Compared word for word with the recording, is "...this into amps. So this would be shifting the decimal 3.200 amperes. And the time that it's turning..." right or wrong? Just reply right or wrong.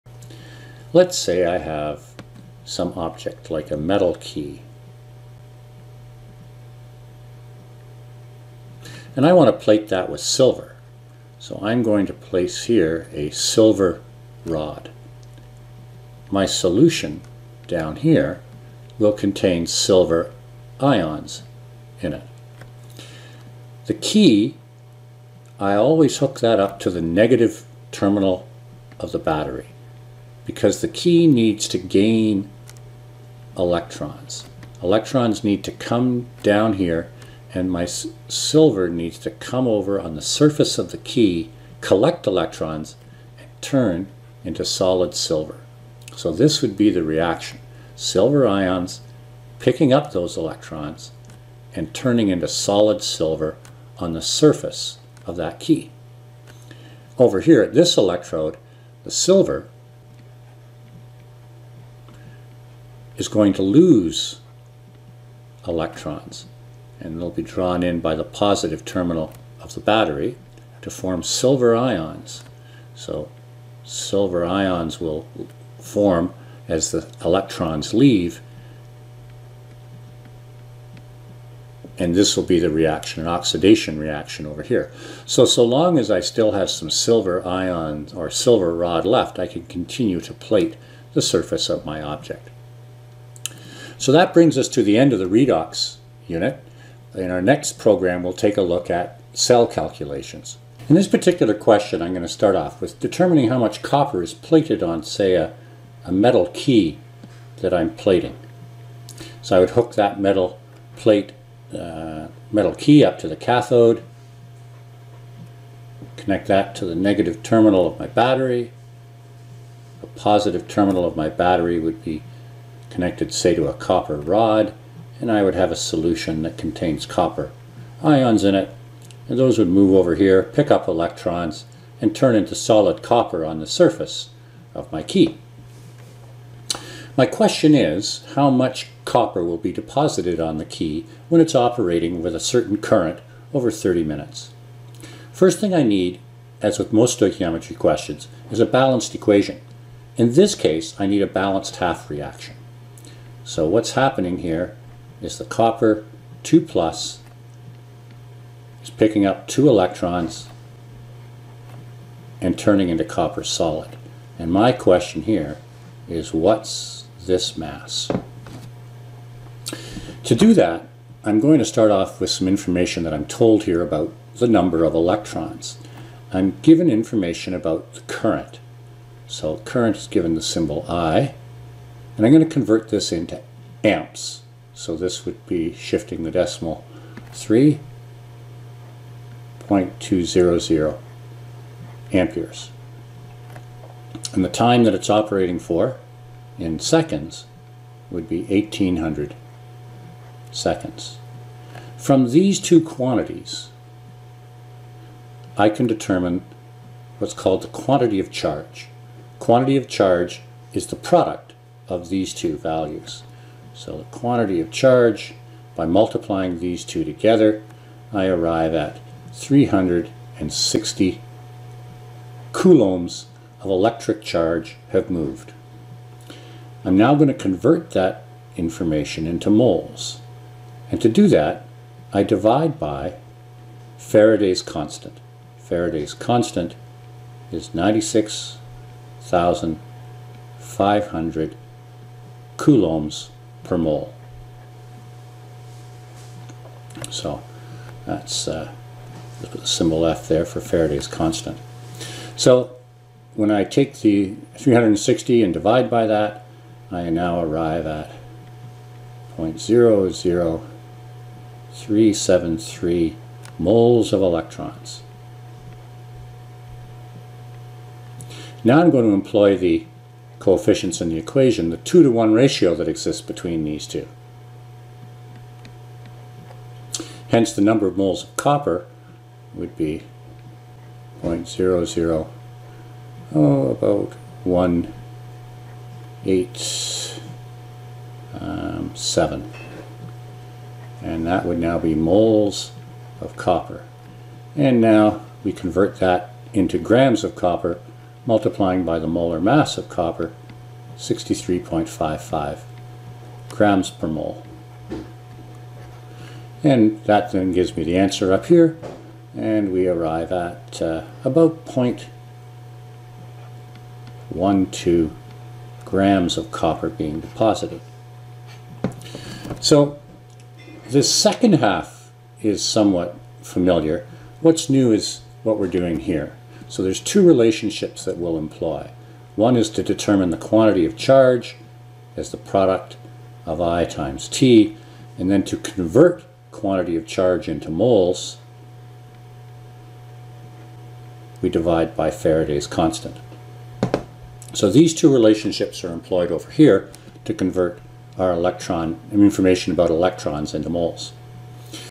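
wrong.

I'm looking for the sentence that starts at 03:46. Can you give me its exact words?
I'm now going to convert that information into moles.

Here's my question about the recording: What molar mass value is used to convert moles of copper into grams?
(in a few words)
63.55 grams per mole.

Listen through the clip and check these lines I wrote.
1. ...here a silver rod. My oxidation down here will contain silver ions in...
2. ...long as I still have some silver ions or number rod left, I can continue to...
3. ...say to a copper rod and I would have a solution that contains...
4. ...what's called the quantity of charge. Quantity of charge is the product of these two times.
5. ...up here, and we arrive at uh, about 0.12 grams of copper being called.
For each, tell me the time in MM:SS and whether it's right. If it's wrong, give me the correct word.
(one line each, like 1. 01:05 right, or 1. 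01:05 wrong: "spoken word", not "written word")
1. 00:12 wrong: "solution", not "oxidation"
2. 01:25 wrong: "silver", not "number"
3. 02:03 right
4. 03:27 wrong: "values", not "times"
5. 05:08 wrong: "deposited", not "called".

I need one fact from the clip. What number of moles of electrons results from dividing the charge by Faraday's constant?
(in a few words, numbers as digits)
0.00373 moles.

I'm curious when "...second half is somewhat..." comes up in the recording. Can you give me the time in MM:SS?
05:21.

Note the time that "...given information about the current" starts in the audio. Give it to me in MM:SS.
02:56.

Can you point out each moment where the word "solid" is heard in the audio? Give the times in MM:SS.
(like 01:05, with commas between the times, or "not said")
00:44, 00:52, 02:12, 02:43.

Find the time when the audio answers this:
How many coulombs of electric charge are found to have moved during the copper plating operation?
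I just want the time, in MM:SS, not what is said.
03:39.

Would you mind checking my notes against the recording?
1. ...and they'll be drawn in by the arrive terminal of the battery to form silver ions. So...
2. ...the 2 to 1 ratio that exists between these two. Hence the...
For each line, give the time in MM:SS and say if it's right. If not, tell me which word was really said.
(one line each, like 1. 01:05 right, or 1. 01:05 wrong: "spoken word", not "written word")
1. 01:06 wrong: "positive", not "arrive"
2. 04:31 right.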